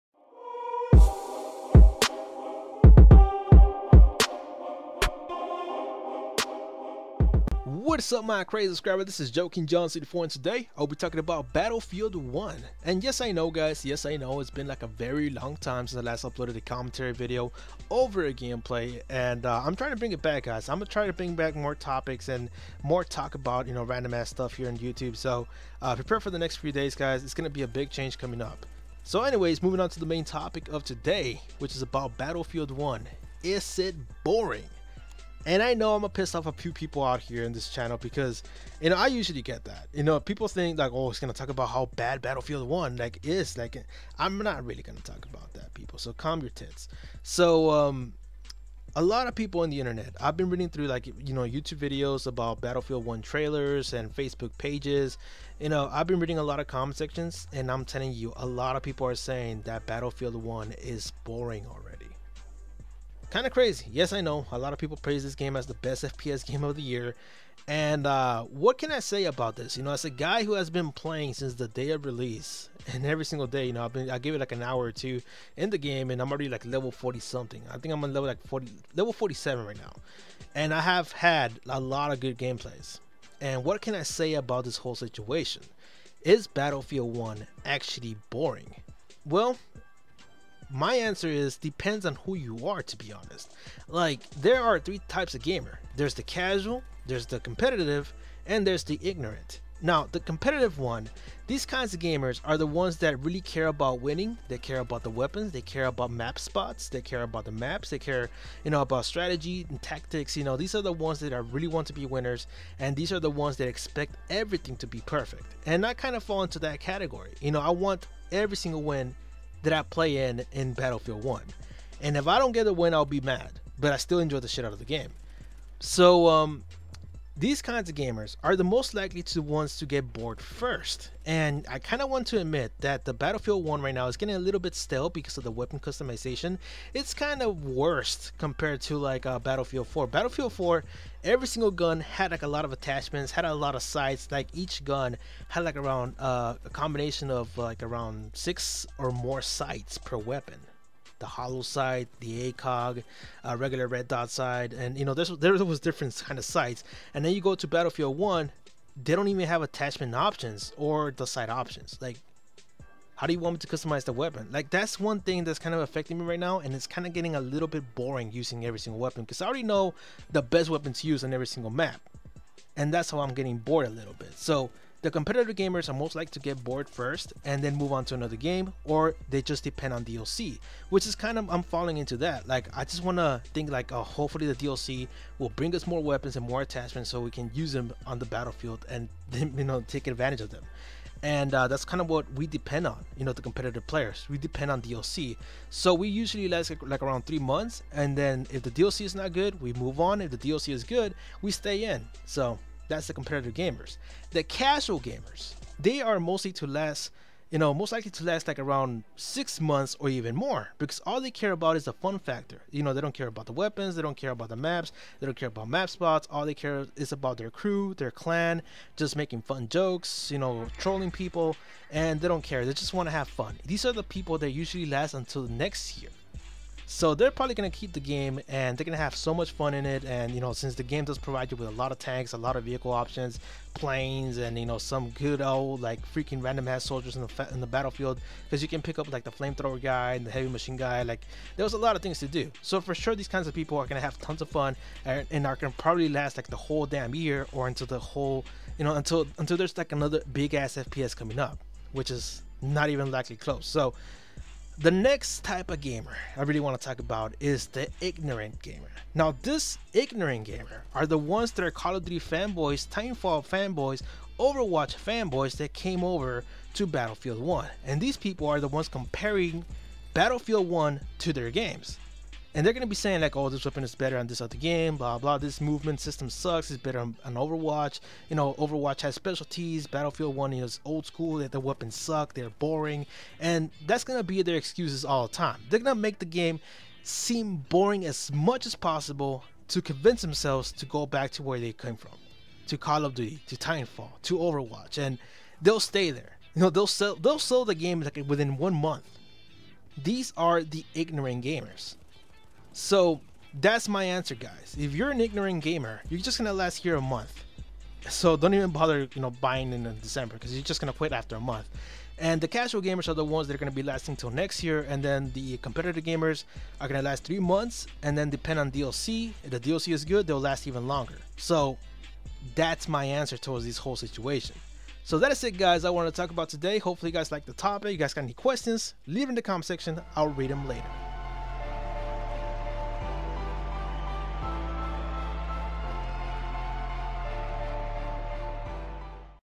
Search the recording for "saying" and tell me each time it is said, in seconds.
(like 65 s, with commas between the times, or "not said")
59 s, 272 s.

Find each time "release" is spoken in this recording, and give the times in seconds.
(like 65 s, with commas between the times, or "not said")
72 s.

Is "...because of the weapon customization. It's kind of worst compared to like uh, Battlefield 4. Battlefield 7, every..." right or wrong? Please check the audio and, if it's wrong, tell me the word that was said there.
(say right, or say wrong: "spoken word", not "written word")
wrong: "4", not "7".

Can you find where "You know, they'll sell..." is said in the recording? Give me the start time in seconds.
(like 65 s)
296 s.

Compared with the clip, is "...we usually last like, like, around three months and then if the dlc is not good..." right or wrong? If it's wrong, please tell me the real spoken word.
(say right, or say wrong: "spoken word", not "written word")
right.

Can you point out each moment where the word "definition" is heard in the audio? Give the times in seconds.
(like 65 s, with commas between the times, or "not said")
not said.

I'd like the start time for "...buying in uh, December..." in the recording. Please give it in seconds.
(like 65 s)
309 s.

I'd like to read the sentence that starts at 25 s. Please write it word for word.
So uh, prepare for the next few days guys, it's going to be a big change coming up.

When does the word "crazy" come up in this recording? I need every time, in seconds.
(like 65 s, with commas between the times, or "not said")
8 s, 63 s.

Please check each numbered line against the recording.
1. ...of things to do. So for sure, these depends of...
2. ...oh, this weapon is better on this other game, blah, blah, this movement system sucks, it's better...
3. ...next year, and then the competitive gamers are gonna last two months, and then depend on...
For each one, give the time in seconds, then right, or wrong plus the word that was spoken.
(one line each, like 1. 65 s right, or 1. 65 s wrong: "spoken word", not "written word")
1. 241 s wrong: "kinds", not "depends"
2. 273 s right
3. 314 s wrong: "three", not "two".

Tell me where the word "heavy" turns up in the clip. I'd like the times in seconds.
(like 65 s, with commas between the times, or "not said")
240 s.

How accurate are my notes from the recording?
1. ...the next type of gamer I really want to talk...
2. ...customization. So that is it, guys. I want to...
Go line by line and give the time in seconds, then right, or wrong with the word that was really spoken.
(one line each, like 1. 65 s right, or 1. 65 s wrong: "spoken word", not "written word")
1. 254 s right
2. 323 s wrong: "situation", not "customization".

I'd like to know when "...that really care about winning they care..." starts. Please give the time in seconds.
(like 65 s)
102 s.